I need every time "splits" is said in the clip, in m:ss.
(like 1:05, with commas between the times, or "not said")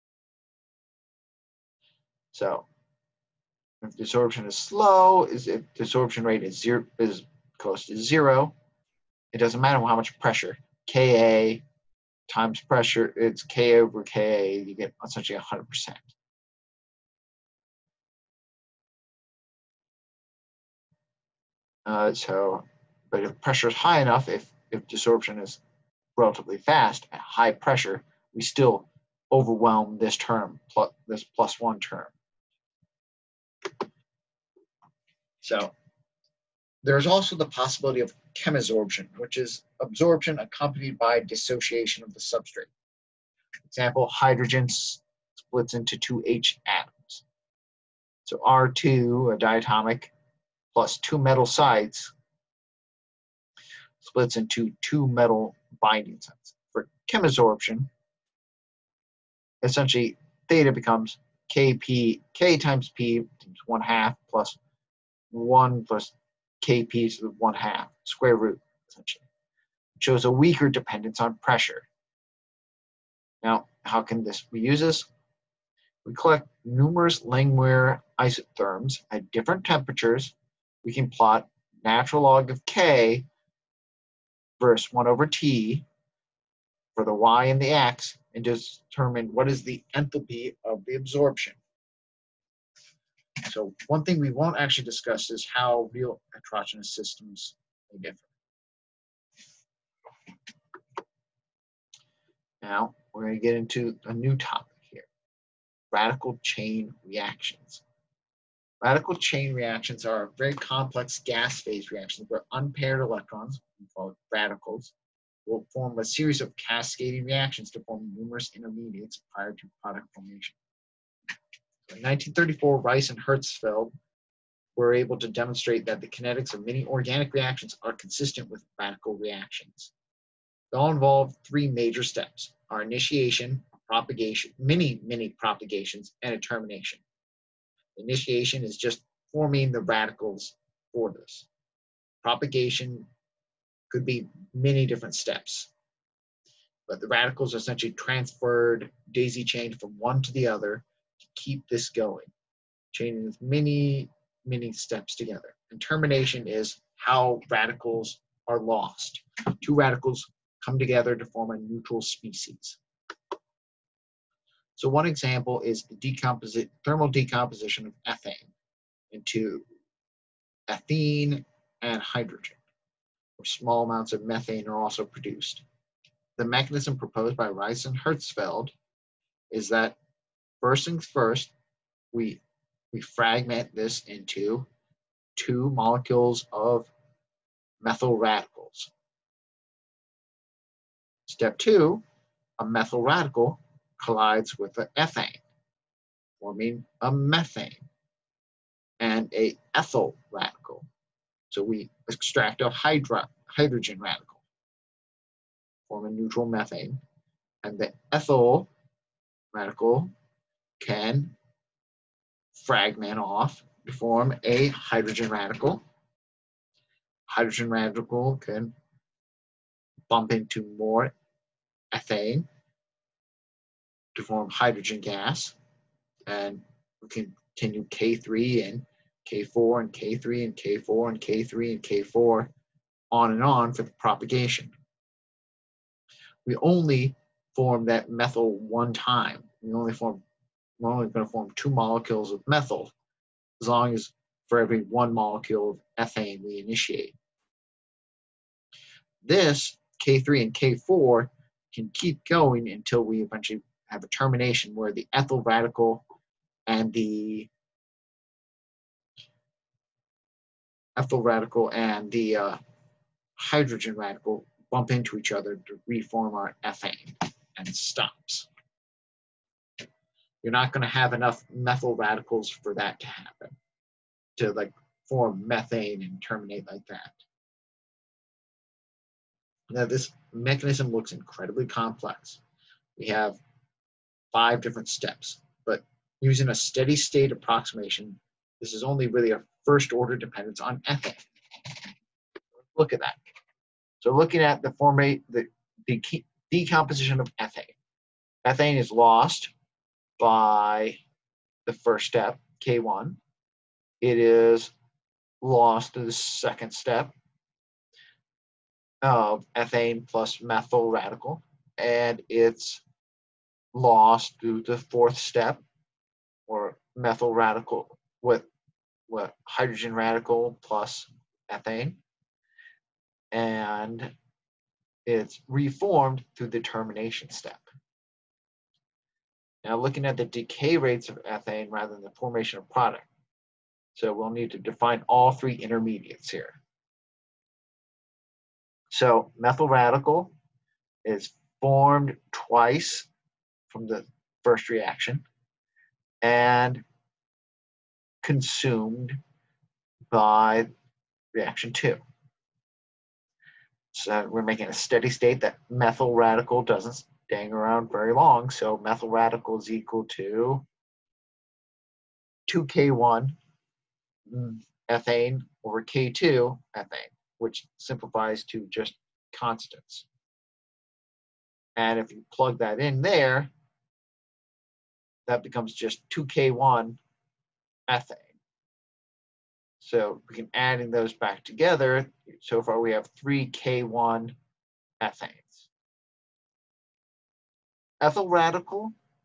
0:44, 0:53.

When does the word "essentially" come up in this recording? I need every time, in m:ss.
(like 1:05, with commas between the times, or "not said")
0:15, 0:59, 1:08, 2:27.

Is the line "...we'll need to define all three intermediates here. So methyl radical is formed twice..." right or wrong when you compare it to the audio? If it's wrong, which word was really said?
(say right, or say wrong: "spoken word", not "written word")
right.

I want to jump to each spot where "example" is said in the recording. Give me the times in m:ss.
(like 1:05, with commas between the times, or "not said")
0:43, 2:45.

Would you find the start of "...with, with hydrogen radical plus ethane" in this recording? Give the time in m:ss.
5:18.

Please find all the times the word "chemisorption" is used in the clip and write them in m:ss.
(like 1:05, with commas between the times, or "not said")
0:38, 0:57.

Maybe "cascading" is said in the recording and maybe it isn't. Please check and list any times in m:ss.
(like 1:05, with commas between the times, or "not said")
1:56.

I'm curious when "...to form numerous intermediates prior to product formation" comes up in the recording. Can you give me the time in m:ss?
1:57.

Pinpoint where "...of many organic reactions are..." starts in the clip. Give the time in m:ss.
2:06.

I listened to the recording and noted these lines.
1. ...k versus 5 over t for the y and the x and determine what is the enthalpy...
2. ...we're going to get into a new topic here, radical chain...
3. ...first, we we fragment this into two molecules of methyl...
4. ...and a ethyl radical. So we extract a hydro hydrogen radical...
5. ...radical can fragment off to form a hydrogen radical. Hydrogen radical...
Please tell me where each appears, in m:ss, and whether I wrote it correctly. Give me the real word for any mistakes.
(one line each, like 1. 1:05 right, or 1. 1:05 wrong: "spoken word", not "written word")
1. 1:22 wrong: "1", not "5"
2. 1:43 right
3. 3:01 right
4. 3:18 right
5. 3:29 right.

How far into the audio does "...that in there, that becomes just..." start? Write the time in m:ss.
6:12.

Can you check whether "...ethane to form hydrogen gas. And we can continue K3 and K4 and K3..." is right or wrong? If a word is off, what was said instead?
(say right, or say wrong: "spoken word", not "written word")
right.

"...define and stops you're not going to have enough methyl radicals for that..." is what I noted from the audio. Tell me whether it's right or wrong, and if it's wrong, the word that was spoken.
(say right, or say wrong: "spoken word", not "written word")
wrong: "ethane", not "define".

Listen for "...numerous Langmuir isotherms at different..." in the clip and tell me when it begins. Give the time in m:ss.
1:16.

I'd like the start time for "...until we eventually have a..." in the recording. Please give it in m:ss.
4:12.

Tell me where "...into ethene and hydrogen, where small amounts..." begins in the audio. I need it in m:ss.
2:49.